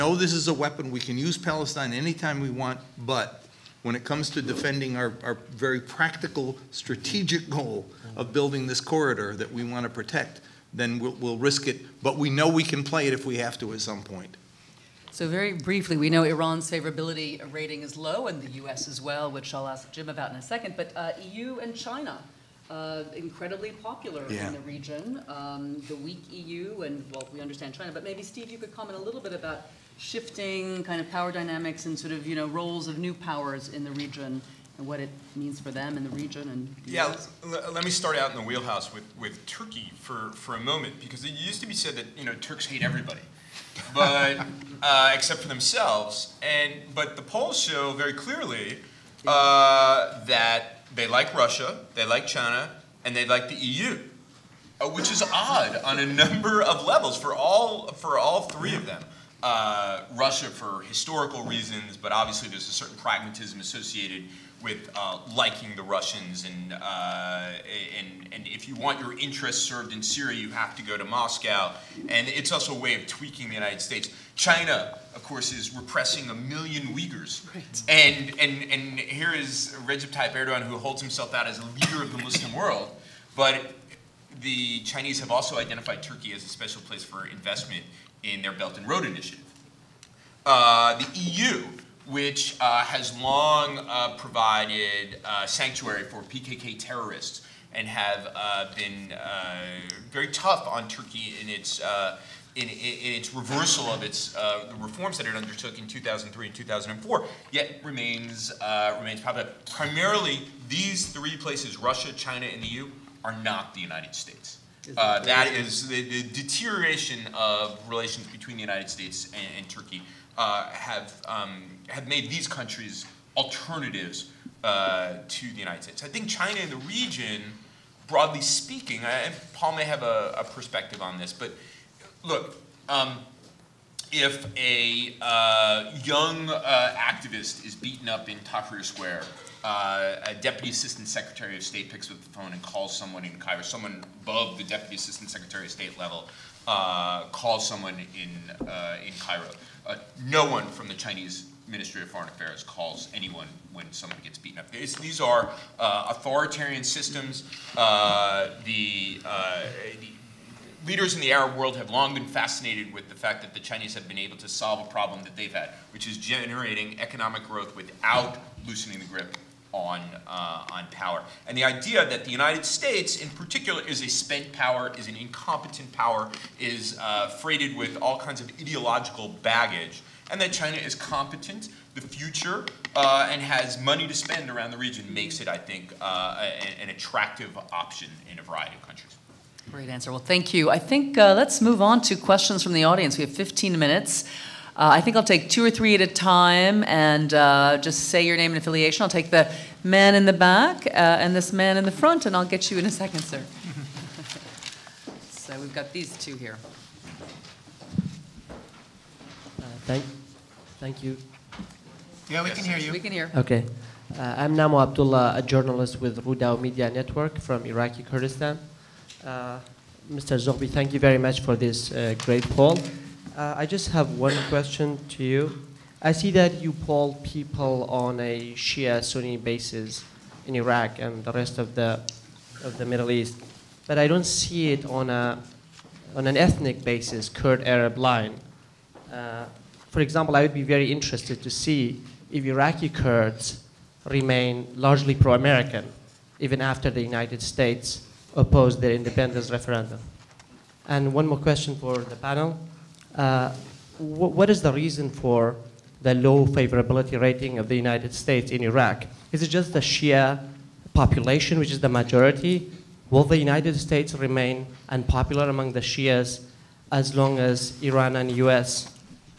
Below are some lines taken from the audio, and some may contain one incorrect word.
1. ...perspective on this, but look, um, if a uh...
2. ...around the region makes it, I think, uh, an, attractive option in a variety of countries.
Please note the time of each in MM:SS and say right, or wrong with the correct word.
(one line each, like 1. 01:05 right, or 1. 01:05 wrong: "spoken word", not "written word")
1. 02:10 right
2. 03:04 right.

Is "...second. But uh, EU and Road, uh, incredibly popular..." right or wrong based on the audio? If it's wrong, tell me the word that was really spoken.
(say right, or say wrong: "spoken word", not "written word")
wrong: "China", not "Road".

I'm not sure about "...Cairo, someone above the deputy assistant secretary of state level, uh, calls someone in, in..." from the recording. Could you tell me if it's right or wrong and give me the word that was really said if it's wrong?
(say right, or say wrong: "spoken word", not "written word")
right.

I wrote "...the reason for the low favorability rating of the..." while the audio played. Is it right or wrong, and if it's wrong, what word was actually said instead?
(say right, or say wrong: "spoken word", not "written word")
right.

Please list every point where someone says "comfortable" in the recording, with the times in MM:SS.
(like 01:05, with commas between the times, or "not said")
not said.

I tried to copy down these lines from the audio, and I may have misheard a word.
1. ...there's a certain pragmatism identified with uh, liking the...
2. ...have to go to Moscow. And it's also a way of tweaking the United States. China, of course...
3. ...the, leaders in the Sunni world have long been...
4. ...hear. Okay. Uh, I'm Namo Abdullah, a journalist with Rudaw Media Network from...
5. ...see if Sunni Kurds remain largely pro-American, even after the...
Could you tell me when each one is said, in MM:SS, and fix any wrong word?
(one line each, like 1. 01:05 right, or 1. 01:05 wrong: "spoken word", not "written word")
1. 01:02 wrong: "associated", not "identified"
2. 01:10 right
3. 02:39 wrong: "Arab", not "Sunni"
4. 03:33 right
5. 04:01 wrong: "Iraqi", not "Sunni".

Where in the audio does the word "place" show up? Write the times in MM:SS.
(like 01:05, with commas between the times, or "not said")
01:26, 01:51.